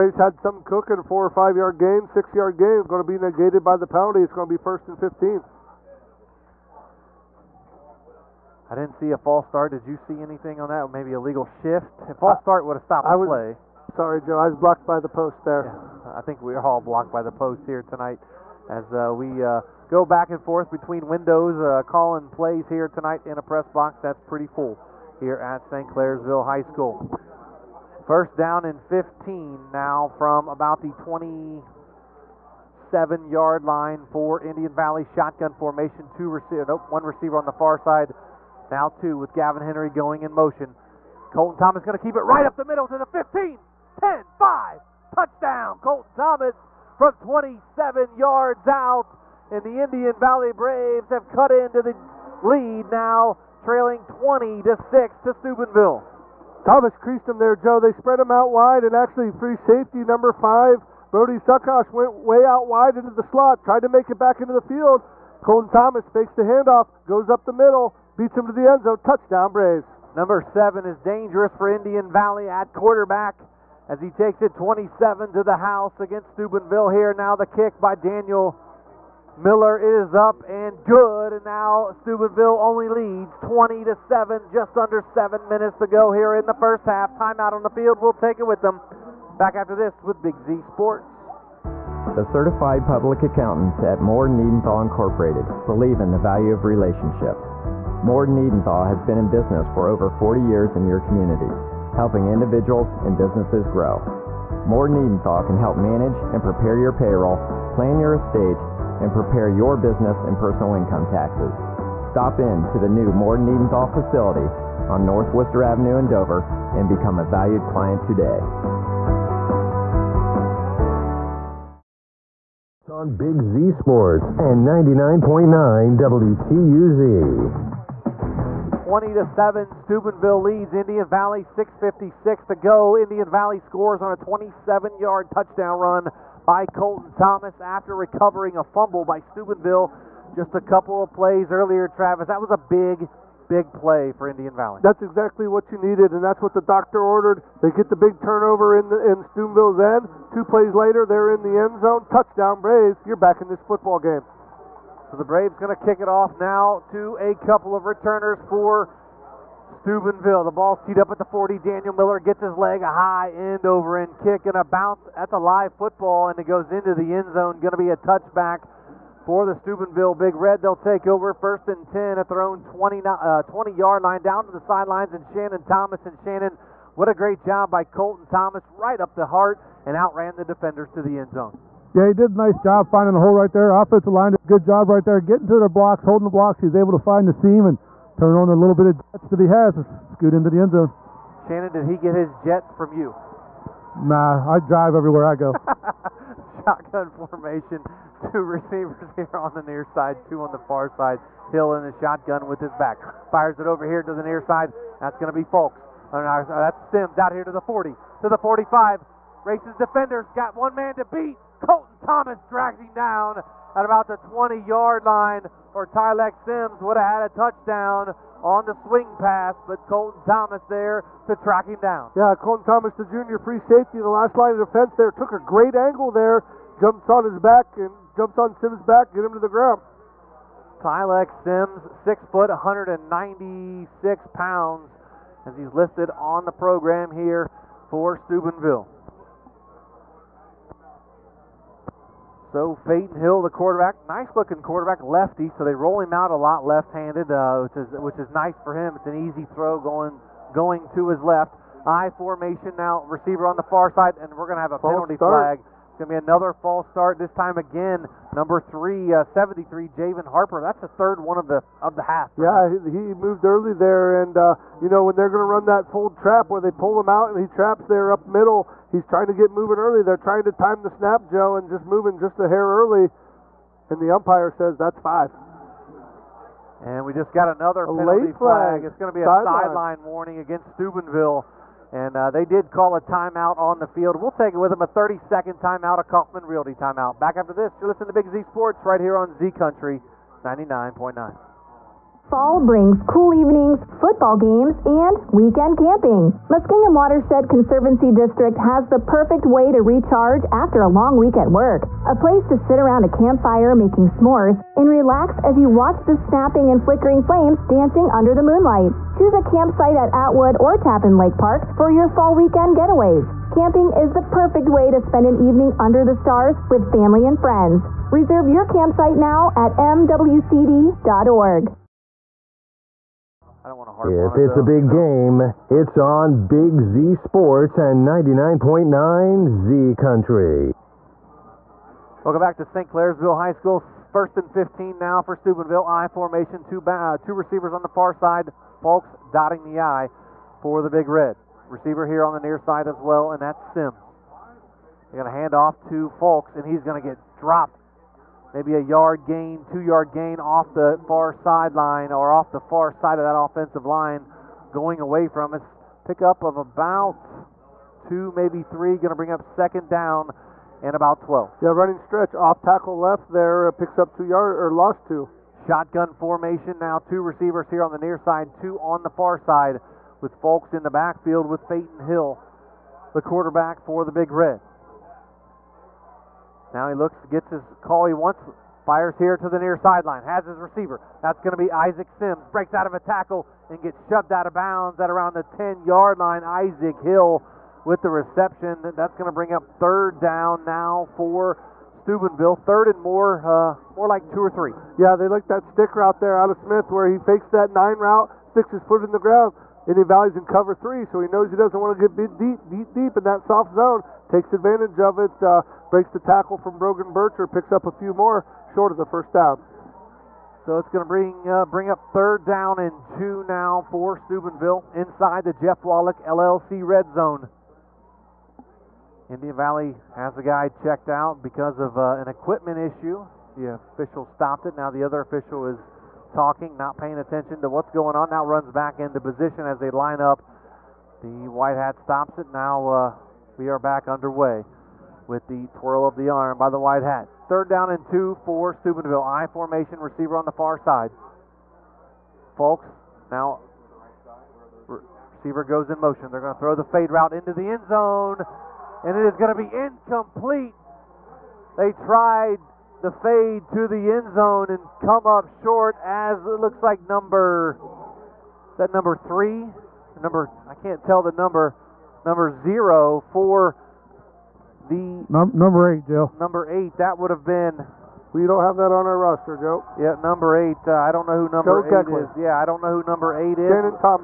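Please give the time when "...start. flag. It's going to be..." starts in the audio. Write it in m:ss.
4:15.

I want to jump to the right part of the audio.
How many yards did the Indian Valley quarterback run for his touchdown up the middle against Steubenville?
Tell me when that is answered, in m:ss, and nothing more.
0:47.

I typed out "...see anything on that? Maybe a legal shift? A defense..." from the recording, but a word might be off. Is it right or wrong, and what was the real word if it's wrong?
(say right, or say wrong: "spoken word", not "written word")
wrong: "false", not "defense".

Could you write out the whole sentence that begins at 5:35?
I formation, two, uh, two receivers on the far side.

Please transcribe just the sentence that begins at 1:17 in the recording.
Now the kick by Daniel Miller is up and good.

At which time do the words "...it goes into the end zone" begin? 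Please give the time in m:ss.
2:46.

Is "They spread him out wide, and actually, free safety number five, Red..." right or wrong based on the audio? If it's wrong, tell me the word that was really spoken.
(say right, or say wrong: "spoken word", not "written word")
wrong: "Brody", not "Red".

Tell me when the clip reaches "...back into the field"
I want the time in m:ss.
1:04.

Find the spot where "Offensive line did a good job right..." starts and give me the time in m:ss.
3:03.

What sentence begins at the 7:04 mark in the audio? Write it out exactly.
Now the other official is talking, not paying attention to what's going on.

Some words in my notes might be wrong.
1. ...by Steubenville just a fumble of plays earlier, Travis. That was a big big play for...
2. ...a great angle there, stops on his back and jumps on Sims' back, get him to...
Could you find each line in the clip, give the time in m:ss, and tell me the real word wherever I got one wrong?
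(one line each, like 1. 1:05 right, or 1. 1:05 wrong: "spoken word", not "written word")
1. 2:19 wrong: "couple", not "fumble"
2. 3:45 wrong: "jumps", not "stops".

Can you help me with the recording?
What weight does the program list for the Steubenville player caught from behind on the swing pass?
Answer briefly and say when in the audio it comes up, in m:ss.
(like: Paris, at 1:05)
196 pounds, at 3:52.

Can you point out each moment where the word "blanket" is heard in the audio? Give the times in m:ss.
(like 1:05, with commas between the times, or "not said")
not said.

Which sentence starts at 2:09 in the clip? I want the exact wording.
Steubenville leads Indian Valley 656 to go.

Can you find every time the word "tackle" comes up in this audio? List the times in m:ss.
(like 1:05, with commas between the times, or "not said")
6:02, 6:22, 6:46.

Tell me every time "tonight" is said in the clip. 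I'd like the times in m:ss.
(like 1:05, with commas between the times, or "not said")
0:17, 0:22.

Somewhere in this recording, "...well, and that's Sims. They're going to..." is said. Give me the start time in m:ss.
5:43.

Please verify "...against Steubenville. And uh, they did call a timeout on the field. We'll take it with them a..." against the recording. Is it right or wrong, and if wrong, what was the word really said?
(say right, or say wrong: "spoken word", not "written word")
right.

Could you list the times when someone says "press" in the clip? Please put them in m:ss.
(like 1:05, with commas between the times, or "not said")
0:23.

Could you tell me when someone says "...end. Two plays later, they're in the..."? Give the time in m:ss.
2:29.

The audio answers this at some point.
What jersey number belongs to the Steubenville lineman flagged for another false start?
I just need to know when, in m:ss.
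4:19.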